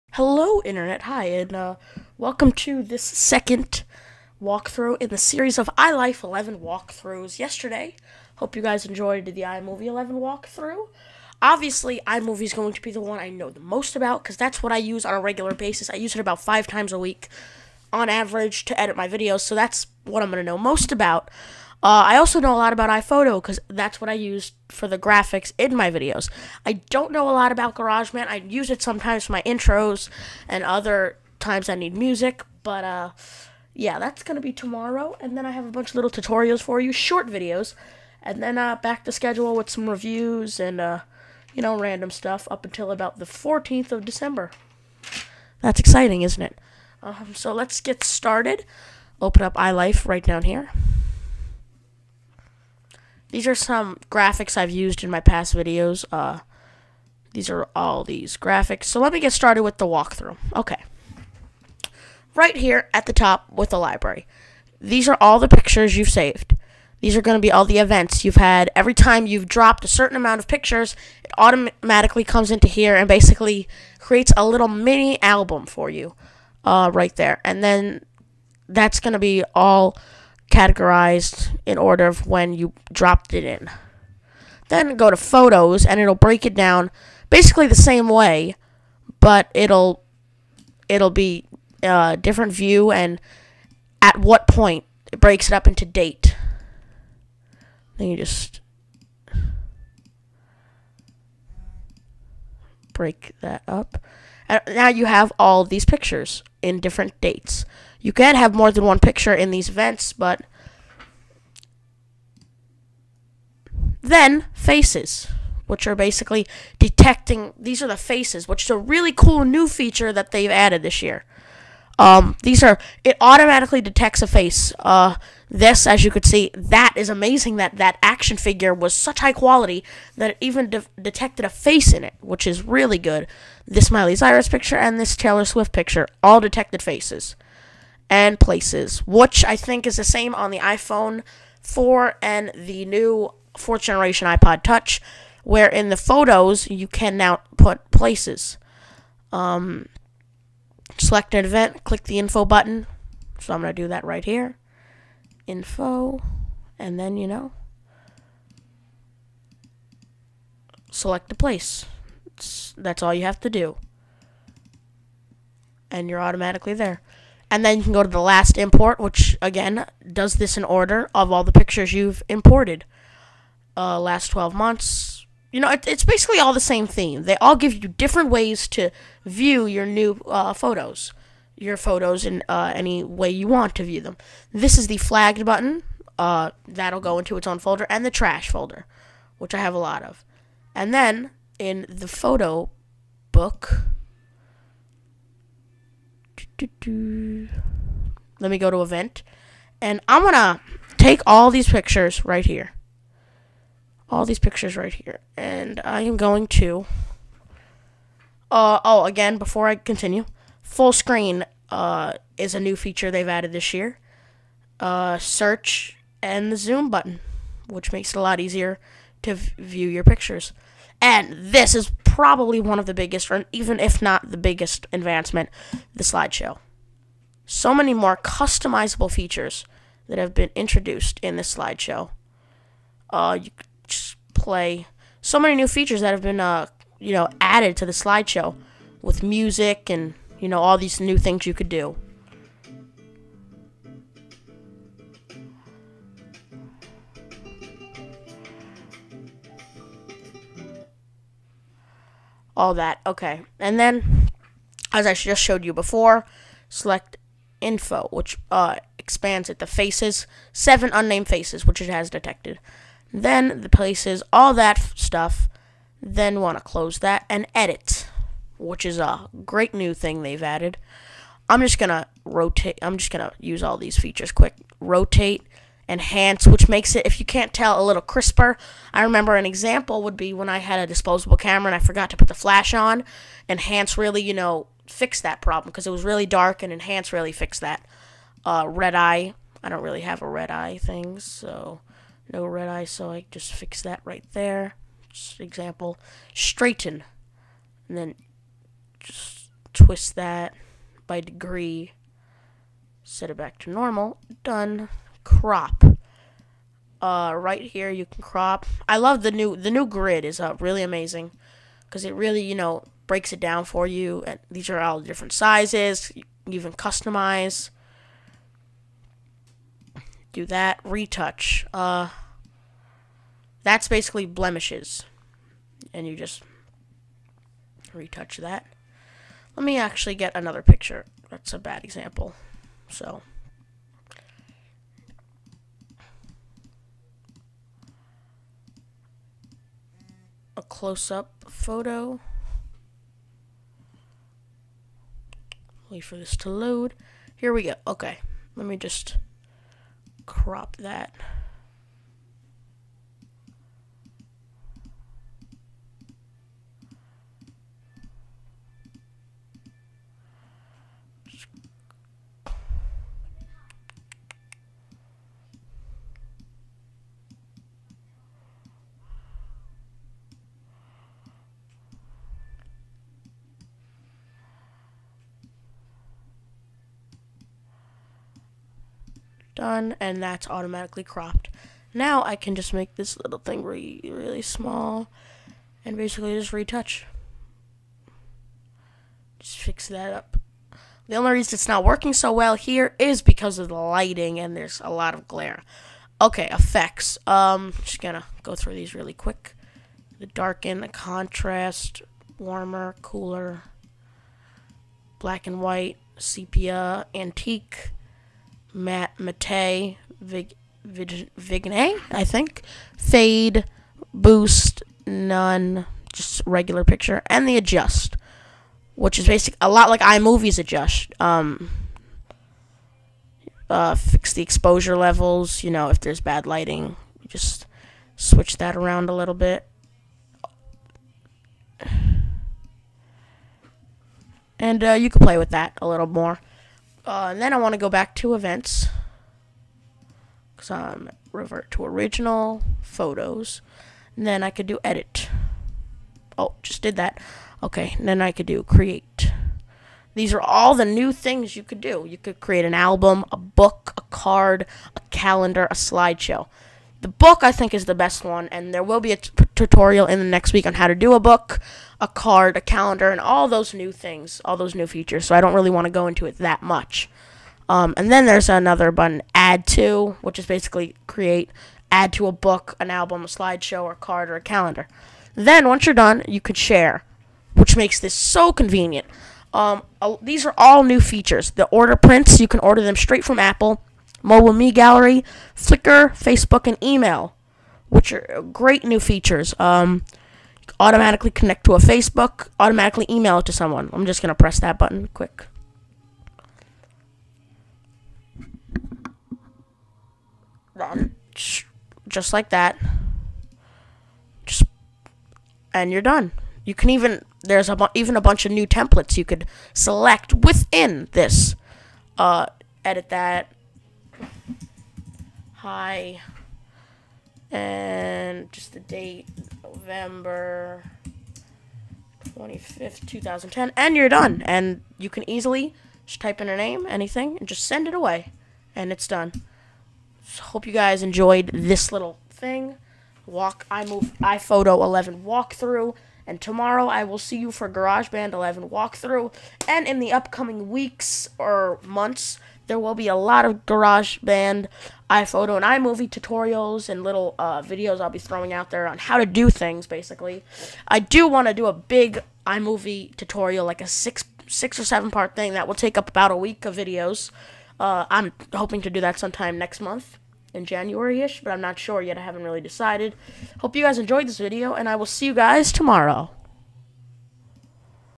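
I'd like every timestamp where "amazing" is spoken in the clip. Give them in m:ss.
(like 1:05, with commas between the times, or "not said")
2:07, 5:10.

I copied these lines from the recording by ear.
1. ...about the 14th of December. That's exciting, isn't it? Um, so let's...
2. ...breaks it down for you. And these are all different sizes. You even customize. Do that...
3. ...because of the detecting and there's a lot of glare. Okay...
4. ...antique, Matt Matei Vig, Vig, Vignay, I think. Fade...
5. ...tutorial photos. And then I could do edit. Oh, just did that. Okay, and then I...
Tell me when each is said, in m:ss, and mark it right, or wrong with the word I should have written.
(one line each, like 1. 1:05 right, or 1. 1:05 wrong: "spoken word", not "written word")
1. 0:42 right
2. 5:13 right
3. 6:33 wrong: "lighting", not "detecting"
4. 6:47 right
5. 7:21 wrong: "original", not "tutorial".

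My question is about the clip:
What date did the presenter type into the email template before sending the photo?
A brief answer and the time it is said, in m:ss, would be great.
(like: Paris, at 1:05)
November 25, 2010, at 8:39.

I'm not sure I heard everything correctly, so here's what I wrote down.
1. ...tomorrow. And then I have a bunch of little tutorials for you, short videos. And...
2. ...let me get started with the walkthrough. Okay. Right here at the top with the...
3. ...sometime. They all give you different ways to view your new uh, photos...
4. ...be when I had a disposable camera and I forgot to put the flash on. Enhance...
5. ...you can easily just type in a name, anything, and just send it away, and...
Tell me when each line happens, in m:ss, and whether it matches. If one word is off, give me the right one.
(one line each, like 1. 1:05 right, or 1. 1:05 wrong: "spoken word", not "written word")
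1. 0:34 right
2. 0:58 right
3. 2:56 wrong: "theme", not "sometime"
4. 4:40 right
5. 8:44 right.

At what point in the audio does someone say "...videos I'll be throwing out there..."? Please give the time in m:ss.
9:07.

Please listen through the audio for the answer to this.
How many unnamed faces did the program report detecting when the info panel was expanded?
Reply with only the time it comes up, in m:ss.
4:20.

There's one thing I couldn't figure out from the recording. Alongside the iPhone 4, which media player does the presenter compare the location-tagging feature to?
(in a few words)
fourth generation iPod Touch.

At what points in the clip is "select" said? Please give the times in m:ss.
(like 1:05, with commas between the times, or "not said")
2:30, 2:40, 4:16, 8:29.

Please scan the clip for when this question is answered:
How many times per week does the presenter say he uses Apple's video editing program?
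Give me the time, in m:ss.
0:16.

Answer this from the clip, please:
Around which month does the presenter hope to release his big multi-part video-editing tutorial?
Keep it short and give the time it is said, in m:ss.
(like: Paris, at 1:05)
January, at 9:20.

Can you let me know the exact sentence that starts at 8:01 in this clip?
The order prints, you can order them straight from Apple mobile me gallery, Flickr, Facebook, and email, which are great new features.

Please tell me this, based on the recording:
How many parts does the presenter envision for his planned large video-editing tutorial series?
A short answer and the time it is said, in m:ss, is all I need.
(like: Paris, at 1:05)
6 or 7, at 9:14.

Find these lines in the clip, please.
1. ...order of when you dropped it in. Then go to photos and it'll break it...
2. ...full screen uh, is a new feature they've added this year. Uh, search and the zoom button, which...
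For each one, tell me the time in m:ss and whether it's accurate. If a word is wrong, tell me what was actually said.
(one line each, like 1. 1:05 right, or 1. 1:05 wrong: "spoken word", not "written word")
1. 1:21 right
2. 3:30 right.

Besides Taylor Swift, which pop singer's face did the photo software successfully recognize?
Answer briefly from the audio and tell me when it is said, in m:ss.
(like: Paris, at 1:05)
Miley Cyrus, at 2:13.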